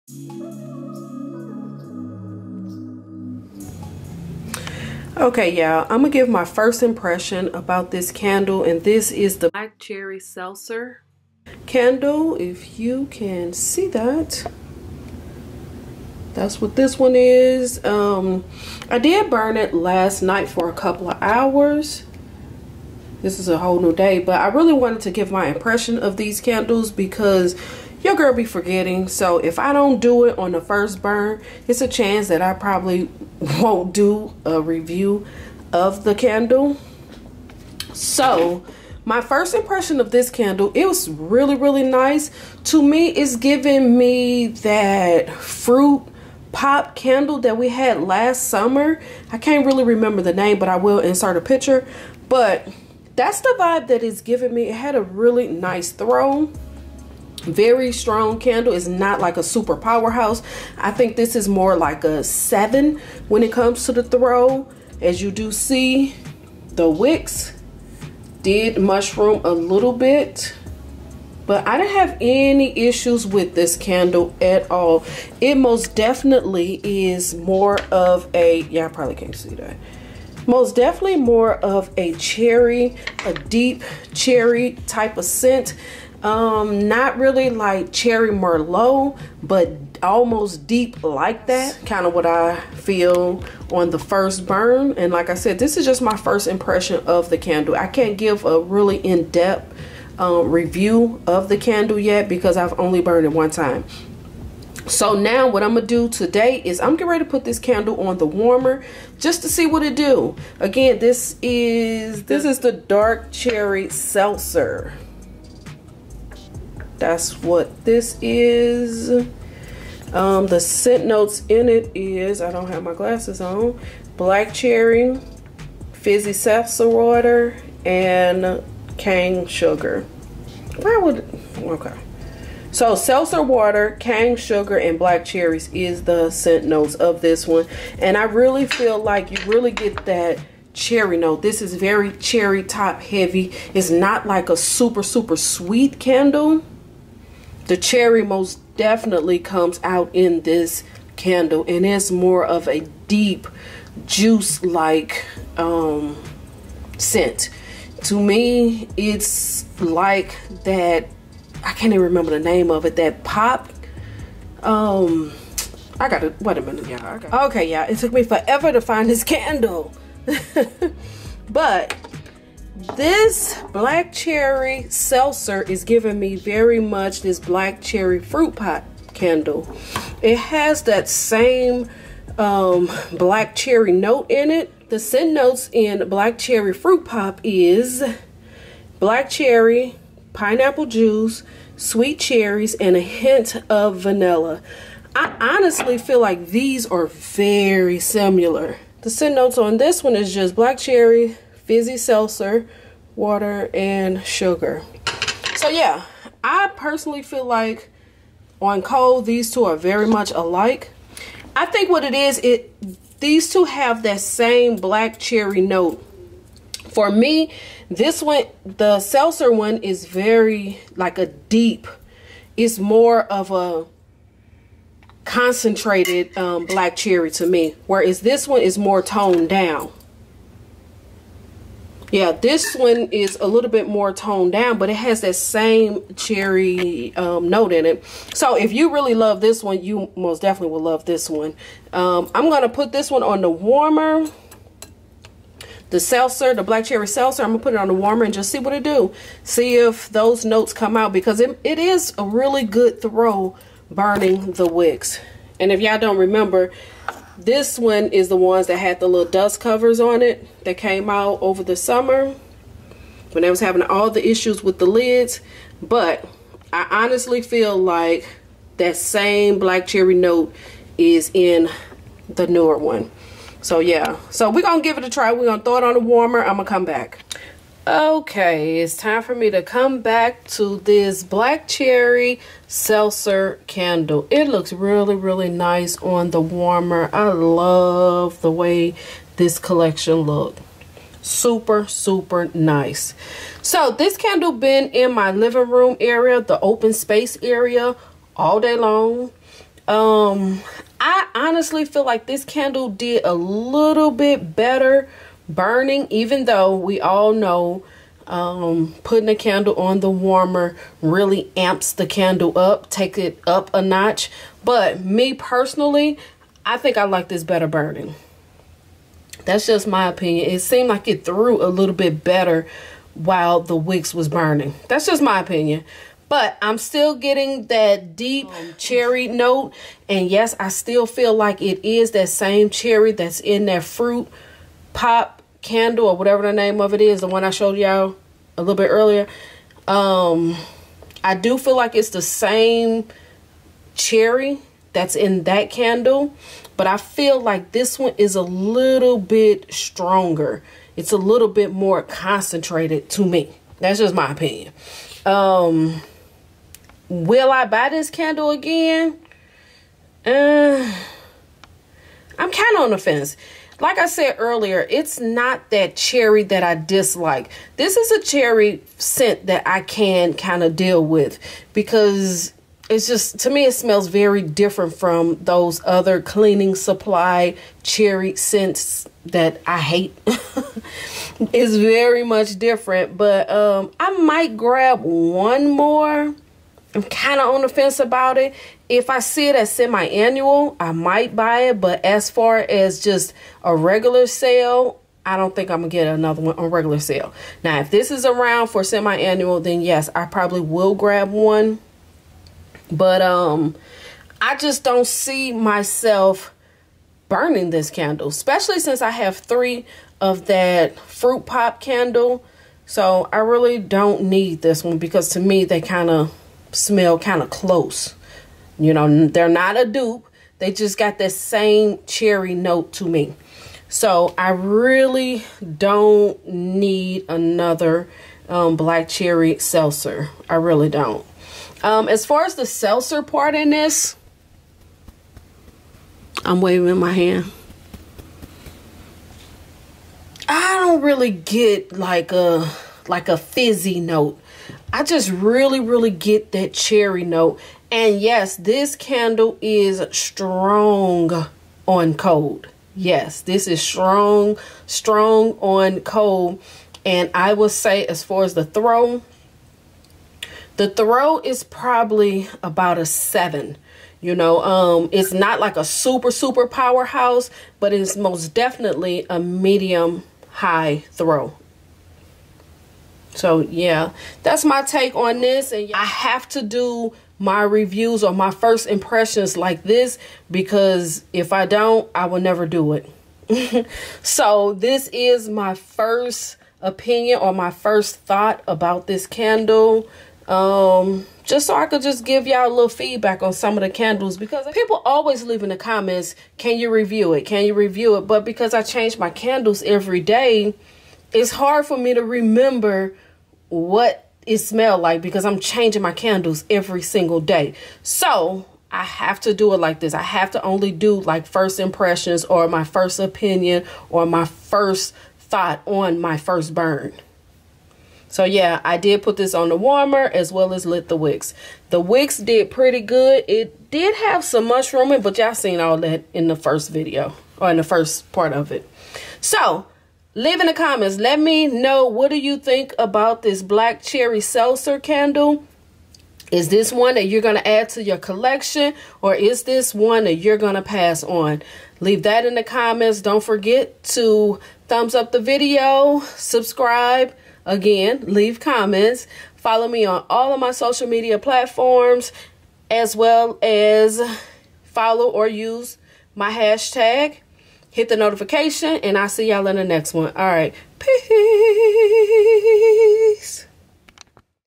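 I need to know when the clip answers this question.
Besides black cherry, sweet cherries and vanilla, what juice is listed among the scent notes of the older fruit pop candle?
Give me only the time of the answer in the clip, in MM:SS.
03:10.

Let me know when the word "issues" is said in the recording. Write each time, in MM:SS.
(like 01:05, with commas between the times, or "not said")
01:12, 04:24.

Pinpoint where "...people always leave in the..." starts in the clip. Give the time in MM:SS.
08:14.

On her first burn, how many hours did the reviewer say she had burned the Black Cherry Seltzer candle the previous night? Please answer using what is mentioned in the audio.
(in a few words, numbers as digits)
a couple of hours.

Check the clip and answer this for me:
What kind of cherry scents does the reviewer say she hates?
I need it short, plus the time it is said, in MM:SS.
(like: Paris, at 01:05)
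cleaning supply cherry scents, at 06:16.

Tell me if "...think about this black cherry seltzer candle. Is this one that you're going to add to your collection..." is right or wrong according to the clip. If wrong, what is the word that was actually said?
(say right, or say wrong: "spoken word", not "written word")
right.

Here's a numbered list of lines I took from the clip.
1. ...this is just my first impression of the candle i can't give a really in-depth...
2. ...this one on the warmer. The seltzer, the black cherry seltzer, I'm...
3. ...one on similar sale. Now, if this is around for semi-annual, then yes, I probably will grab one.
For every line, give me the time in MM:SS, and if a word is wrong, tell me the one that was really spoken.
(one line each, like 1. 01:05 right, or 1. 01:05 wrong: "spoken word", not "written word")
1. 01:35 right
2. 04:02 right
3. 06:36 wrong: "regular", not "similar".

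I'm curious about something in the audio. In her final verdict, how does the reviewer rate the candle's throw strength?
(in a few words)
medium high throw.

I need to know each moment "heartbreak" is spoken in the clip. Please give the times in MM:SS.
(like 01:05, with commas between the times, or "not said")
not said.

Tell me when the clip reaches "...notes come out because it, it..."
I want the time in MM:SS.
04:10.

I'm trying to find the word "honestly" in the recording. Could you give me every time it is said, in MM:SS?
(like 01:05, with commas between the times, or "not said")
03:15, 04:27, 05:01.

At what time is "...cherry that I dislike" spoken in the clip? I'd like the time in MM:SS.
06:05.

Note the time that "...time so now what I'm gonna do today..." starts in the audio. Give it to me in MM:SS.
01:43.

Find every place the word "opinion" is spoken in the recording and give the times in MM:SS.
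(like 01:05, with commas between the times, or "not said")
05:20, 05:25, 05:54, 08:06, 08:33.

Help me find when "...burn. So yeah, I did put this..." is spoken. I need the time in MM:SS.
08:36.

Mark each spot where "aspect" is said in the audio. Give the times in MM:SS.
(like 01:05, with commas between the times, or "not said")
not said.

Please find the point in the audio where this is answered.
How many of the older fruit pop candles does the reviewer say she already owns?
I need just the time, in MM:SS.
06:49.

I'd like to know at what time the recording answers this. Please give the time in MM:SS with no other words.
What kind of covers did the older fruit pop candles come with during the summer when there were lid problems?
04:19.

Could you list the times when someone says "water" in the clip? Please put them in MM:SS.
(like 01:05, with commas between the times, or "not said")
02:06, 02:13, 03:23.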